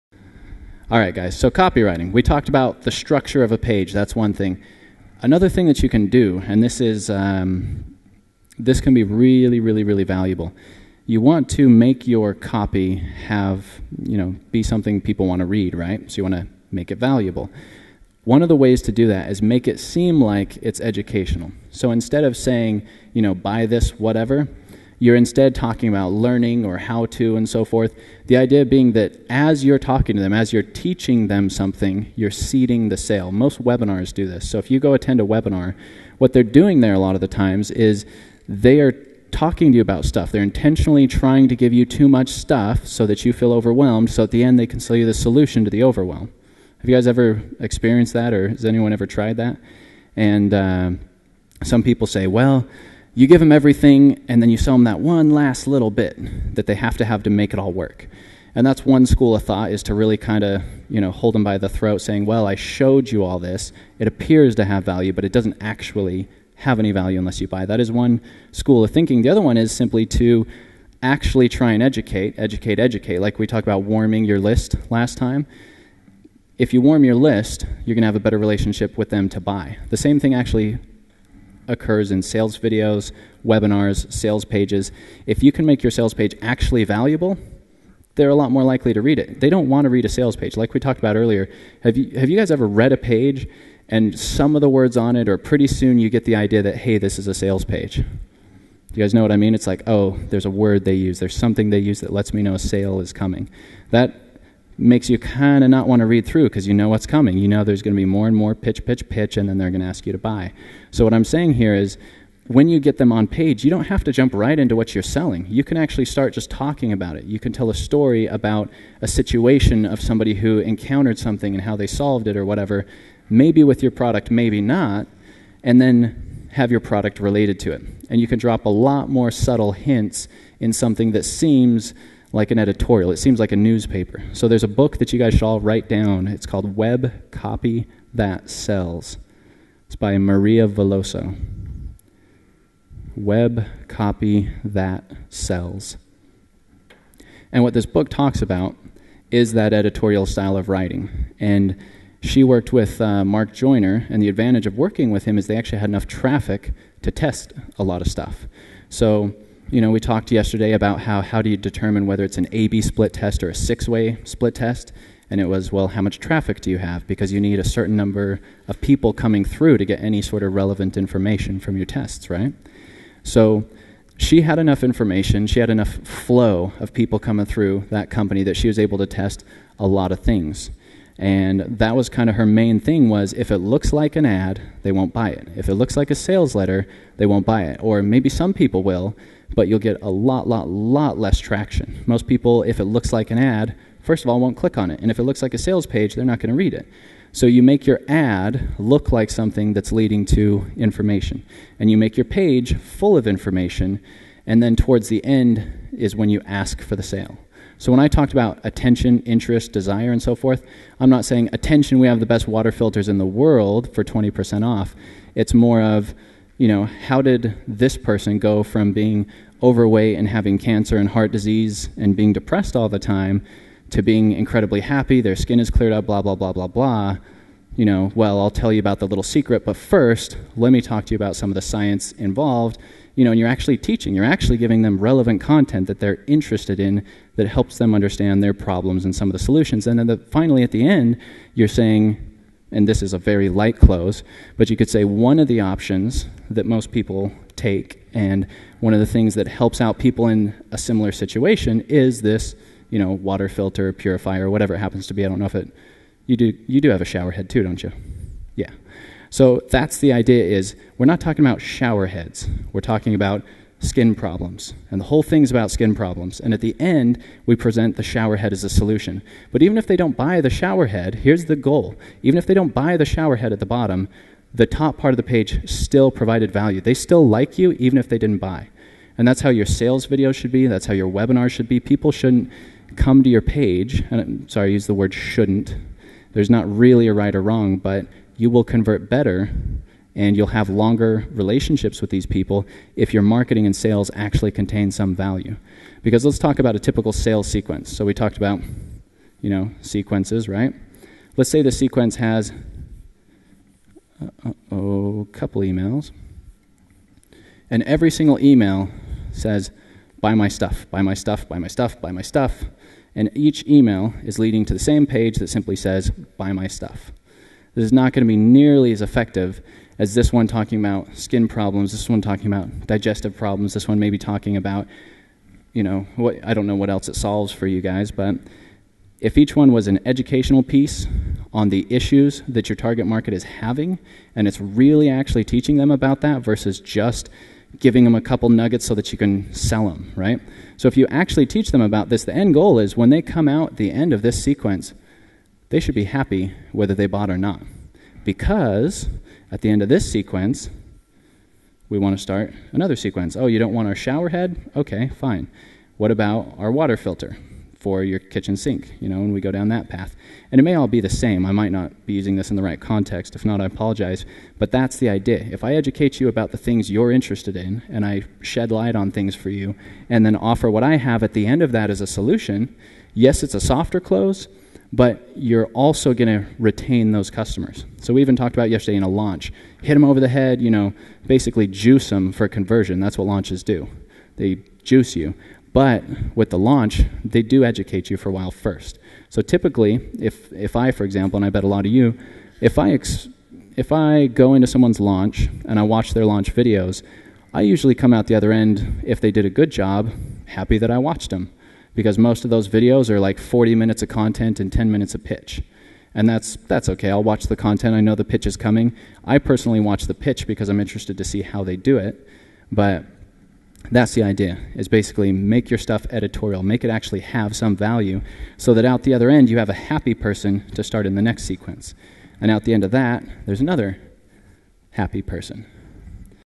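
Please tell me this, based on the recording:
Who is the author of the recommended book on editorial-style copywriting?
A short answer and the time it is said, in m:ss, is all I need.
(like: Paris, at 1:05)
Maria Veloso, at 2:20.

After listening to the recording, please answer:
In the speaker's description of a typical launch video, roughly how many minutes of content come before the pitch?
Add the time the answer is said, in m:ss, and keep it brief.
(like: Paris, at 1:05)
40 minutes, at 6:43.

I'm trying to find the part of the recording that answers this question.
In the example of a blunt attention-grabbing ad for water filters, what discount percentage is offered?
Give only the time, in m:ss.
3:34.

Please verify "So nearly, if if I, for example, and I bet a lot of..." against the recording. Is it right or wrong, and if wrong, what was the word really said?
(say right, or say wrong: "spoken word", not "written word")
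wrong: "typically", not "nearly".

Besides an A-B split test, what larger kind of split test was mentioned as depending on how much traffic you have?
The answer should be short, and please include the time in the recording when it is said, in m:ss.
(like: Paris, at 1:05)
six-way split test, at 2:43.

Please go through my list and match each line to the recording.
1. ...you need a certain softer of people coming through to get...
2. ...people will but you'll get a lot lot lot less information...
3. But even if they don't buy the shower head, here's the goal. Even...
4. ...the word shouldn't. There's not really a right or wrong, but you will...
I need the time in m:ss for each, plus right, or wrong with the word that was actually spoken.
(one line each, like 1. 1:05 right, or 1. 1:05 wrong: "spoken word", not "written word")
1. 2:47 wrong: "number", not "softer"
2. 3:08 wrong: "traction", not "information"
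3. 4:29 right
4. 4:44 right.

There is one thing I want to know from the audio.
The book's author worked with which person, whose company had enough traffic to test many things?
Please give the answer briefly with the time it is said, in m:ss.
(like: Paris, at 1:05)
Mark Joyner, at 2:33.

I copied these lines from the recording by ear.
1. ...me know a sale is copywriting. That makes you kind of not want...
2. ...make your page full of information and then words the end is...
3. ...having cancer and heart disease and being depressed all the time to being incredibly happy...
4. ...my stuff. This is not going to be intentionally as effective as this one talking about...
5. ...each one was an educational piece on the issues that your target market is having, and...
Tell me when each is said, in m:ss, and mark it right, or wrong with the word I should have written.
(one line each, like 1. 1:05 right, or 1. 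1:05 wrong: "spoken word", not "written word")
1. 1:42 wrong: "coming", not "copywriting"
2. 3:21 wrong: "towards", not "words"
3. 3:40 right
4. 5:16 wrong: "nearly", not "intentionally"
5. 5:29 right.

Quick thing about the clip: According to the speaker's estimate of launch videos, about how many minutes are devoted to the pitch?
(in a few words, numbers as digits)
10 minutes.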